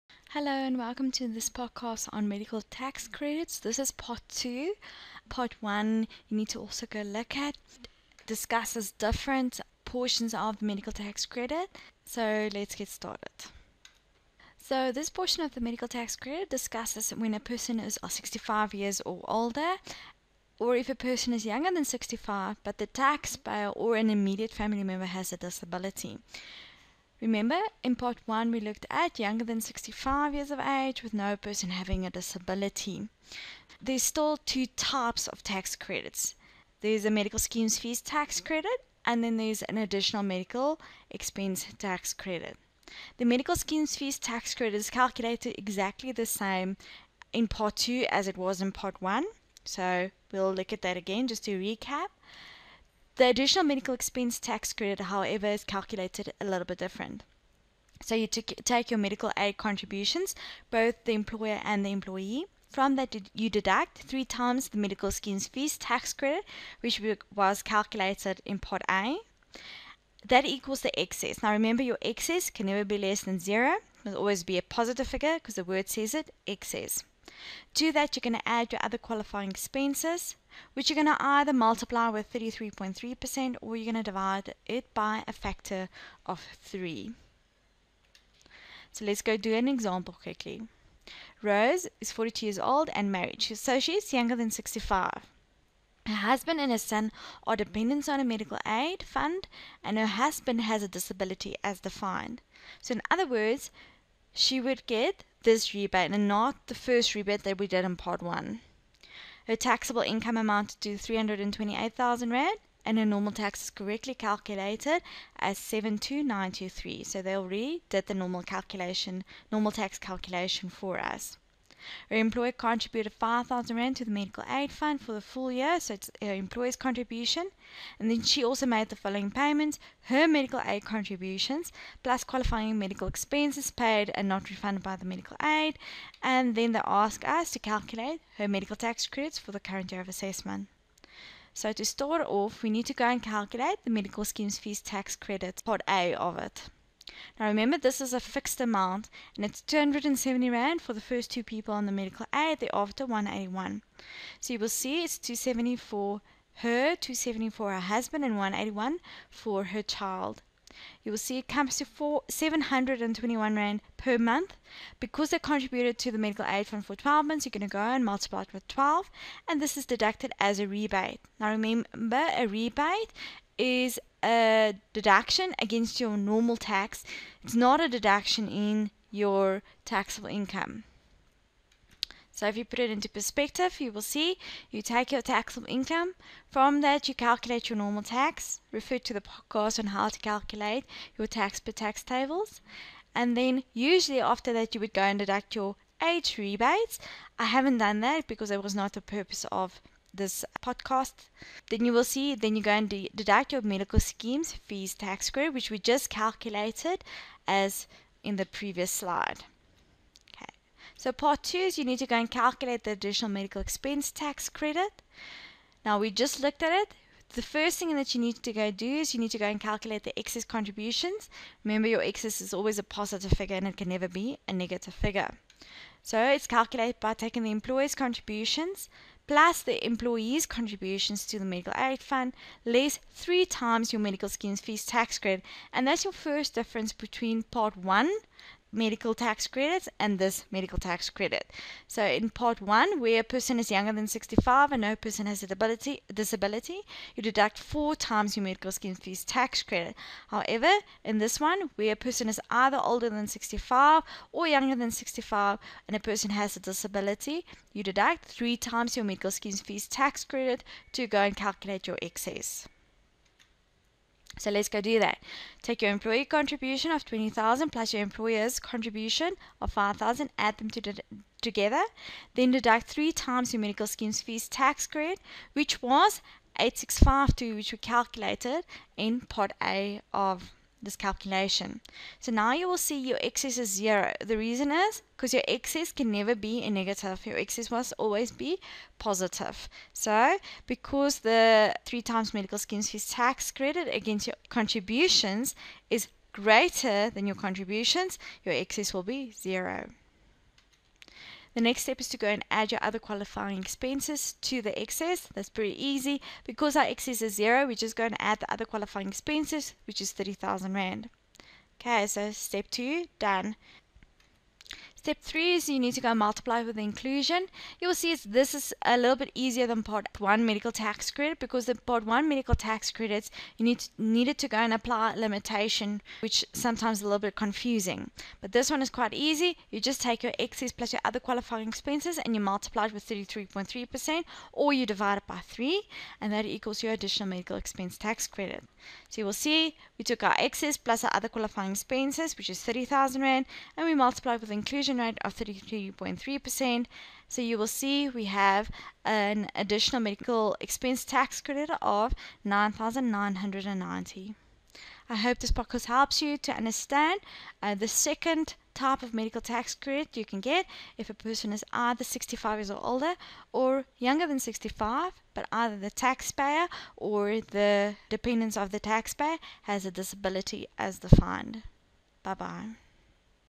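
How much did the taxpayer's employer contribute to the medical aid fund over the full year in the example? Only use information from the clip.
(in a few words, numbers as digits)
5,000 Rand.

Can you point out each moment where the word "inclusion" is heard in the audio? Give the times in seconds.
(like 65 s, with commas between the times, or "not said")
316 s, 344 s.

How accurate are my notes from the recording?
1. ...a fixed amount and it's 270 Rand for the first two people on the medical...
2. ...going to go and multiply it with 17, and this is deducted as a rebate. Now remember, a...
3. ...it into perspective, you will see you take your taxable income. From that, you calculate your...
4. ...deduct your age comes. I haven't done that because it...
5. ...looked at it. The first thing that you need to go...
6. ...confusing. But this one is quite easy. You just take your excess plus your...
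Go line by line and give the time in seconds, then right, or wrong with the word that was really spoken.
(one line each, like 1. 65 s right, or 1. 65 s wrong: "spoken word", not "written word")
1. 148 s right
2. 167 s wrong: "12", not "17"
3. 182 s right
4. 195 s wrong: "rebates", not "comes"
5. 216 s right
6. 327 s right.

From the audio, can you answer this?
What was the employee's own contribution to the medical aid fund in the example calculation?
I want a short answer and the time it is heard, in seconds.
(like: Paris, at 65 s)
20,000, at 267 s.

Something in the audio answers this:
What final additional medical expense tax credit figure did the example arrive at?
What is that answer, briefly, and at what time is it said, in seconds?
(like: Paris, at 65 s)
9,990, at 352 s.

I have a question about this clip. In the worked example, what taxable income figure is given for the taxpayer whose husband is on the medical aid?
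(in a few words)
328,000 Rand.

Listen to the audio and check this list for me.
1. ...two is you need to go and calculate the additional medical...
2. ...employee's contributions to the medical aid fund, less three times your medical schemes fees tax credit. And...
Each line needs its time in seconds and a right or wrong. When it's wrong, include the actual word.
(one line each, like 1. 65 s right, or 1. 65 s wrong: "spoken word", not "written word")
1. 211 s right
2. 229 s right.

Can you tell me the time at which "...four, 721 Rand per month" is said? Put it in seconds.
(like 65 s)
161 s.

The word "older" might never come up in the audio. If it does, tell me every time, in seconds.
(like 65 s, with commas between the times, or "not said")
19 s, 252 s, 362 s.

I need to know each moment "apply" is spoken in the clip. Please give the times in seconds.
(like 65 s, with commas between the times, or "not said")
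324 s.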